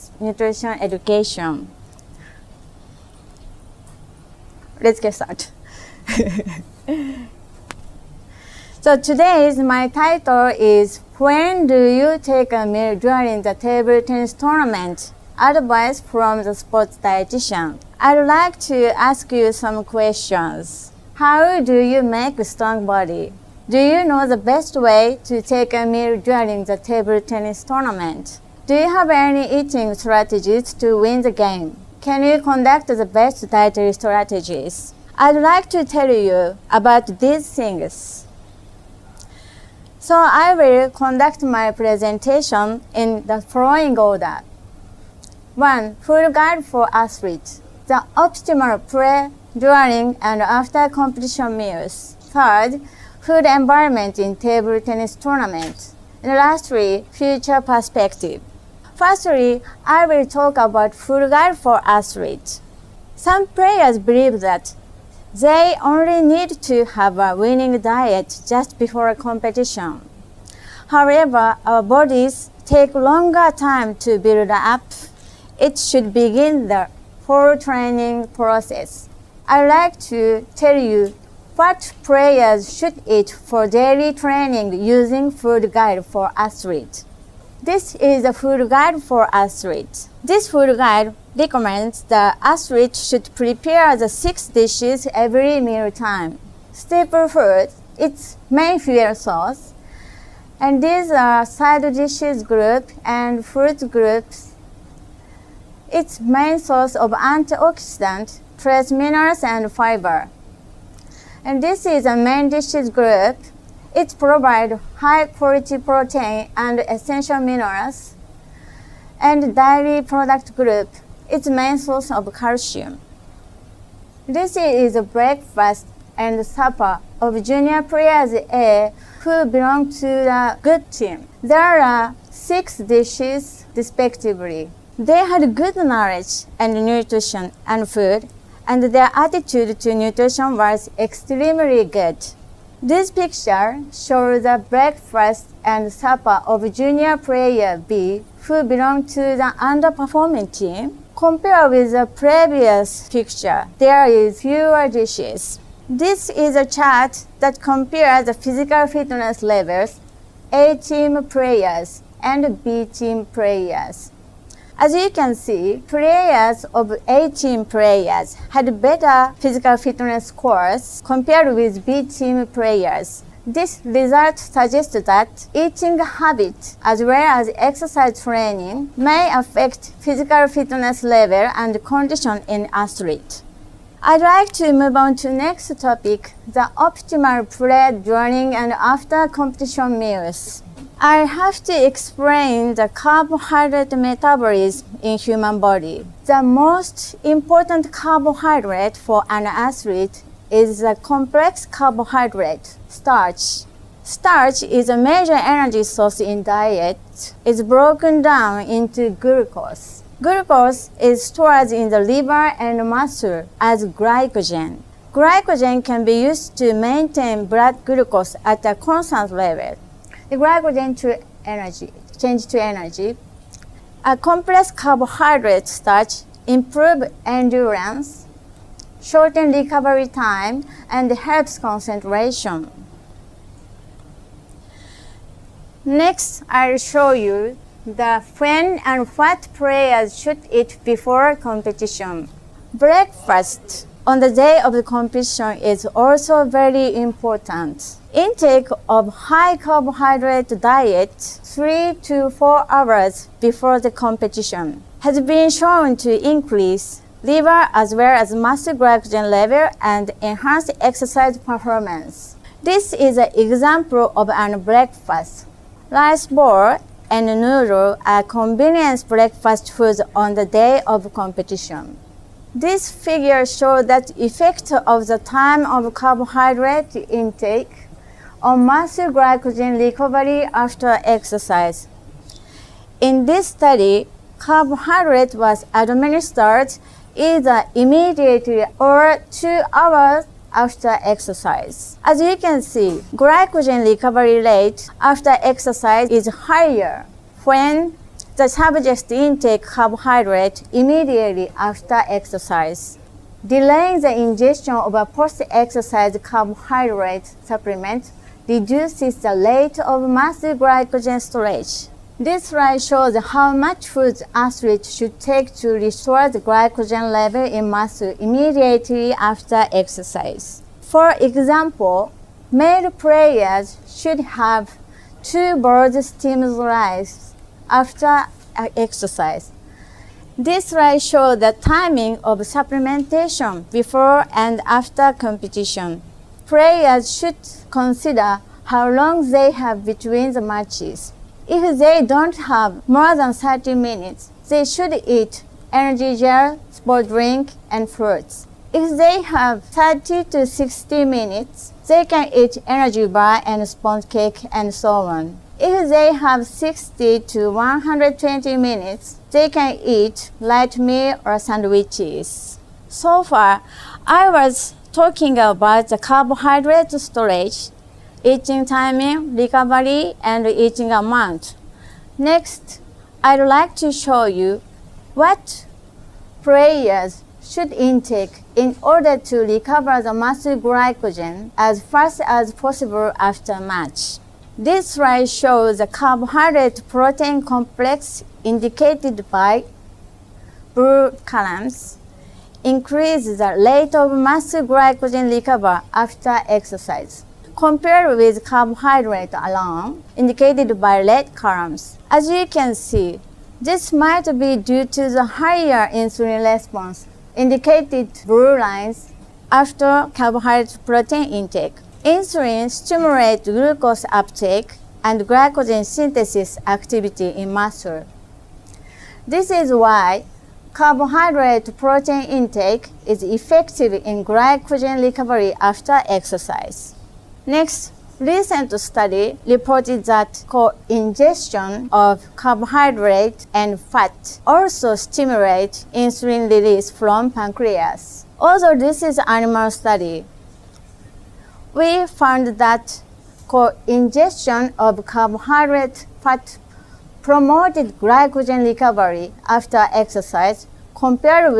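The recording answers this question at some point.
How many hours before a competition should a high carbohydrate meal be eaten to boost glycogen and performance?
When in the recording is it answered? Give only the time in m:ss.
4:11.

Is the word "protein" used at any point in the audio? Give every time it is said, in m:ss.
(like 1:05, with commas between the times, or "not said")
1:55, 6:26, 6:50, 7:01.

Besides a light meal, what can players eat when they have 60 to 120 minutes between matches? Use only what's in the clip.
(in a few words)
sandwiches.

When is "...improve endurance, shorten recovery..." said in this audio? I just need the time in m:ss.
3:46.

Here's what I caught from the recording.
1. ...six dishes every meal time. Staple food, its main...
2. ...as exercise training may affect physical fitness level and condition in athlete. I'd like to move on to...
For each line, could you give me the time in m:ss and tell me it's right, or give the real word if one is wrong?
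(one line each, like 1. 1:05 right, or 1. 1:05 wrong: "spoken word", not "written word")
1. 1:34 right
2. 2:57 right.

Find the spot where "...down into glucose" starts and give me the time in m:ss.
3:28.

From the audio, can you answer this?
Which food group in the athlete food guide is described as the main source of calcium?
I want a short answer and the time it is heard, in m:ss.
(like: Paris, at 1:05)
dairy product group, at 1:59.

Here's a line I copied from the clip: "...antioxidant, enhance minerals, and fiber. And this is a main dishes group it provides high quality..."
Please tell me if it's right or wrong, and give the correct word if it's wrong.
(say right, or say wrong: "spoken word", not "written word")
wrong: "trace", not "enhance".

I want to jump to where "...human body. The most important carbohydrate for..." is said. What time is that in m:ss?
3:15.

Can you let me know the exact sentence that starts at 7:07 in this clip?
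Next, recent study reported that co-ingestion of carbohydrate and fat also stimulate insulin release from pancreas.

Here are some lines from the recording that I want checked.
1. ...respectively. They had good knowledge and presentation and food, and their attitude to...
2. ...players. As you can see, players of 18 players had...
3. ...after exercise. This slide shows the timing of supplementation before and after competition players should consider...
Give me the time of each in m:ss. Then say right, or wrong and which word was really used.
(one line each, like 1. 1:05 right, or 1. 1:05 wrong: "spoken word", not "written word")
1. 2:13 wrong: "nutrition", not "presentation"
2. 2:43 right
3. 5:27 right.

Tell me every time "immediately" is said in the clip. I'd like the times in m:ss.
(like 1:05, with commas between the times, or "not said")
4:47, 5:00, 5:18.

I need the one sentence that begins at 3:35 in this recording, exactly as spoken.
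Glycogen can be used to maintain blood glucose at a constant level.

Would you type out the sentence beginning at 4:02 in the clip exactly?
Breakfast on the day of the competition is also very important.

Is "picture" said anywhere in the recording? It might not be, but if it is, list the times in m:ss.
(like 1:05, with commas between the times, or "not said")
2:23, 2:33.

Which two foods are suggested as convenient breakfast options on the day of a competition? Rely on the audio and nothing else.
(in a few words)
rice bowl and noodle.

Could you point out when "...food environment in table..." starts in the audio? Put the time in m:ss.
0:53.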